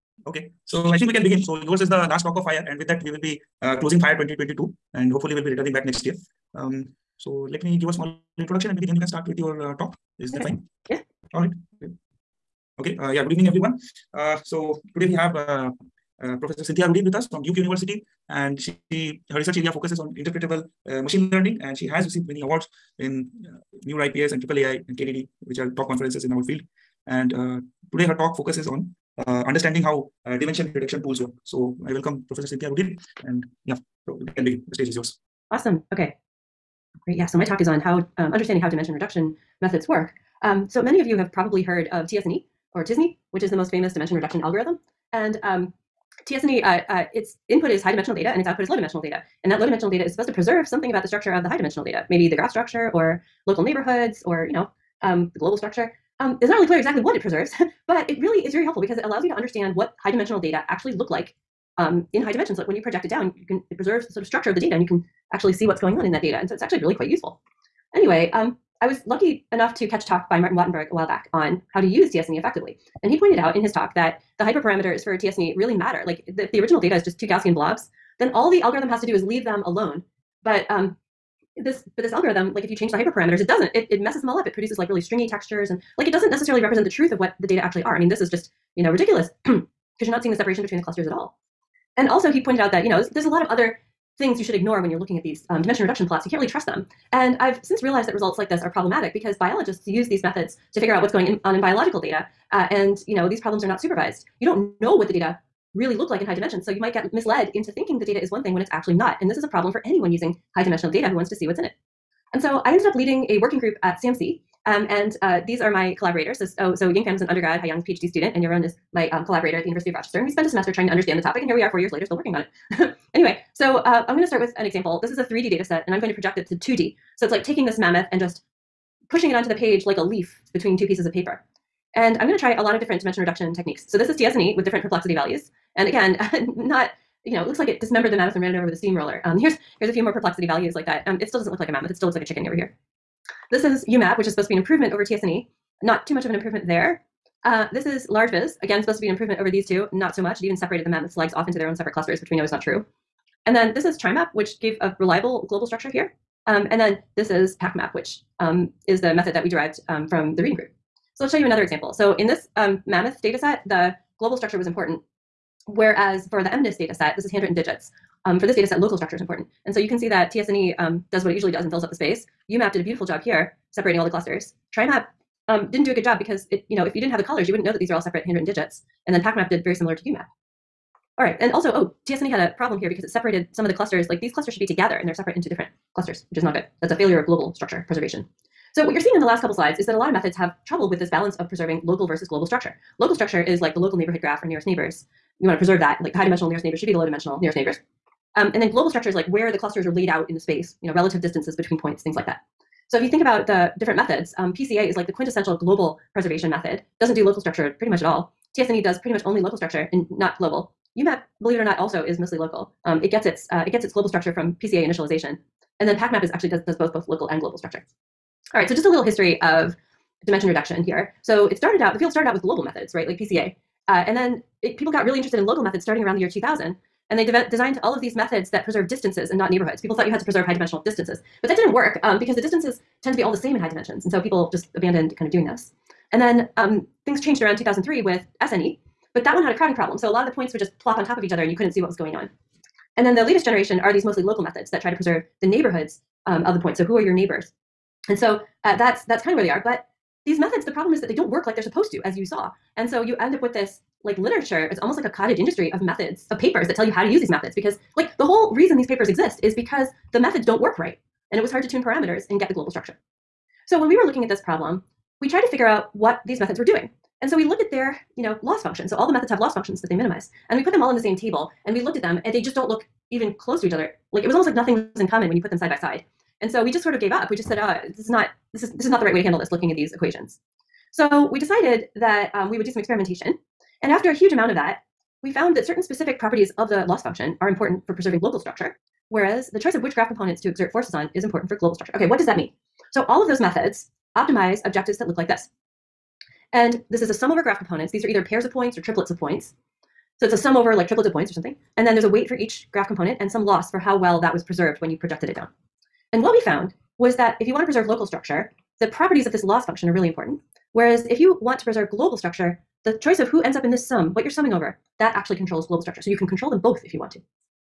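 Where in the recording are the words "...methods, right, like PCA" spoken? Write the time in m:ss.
3:42.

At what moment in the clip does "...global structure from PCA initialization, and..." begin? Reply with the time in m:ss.
3:33.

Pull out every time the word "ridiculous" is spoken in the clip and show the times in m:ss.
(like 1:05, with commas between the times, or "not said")
1:28.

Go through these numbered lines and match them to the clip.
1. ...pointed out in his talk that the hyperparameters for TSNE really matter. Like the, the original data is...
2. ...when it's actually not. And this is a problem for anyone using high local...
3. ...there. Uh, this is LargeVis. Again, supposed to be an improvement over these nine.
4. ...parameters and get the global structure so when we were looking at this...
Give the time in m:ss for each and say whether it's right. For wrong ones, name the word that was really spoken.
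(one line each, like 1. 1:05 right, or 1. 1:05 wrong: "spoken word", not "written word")
1. 1:13 right
2. 1:48 wrong: "dimensional", not "local"
3. 2:26 wrong: "two", not "nine"
4. 4:21 right.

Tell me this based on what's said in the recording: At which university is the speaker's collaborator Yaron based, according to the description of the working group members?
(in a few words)
University of Rochester.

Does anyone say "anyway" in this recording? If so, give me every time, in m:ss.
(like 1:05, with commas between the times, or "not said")
1:07, 2:03.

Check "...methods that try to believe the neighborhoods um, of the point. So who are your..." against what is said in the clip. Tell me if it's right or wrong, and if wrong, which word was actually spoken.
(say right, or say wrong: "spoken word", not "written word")
wrong: "preserve", not "believe".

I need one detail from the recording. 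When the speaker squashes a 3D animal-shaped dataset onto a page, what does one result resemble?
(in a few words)
A chicken.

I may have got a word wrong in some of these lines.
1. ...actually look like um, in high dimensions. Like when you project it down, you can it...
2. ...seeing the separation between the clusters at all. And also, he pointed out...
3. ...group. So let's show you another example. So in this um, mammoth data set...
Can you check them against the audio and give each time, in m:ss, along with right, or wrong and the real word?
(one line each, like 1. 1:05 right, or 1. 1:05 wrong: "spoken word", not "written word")
1. 1:00 right
2. 1:30 right
3. 2:40 right.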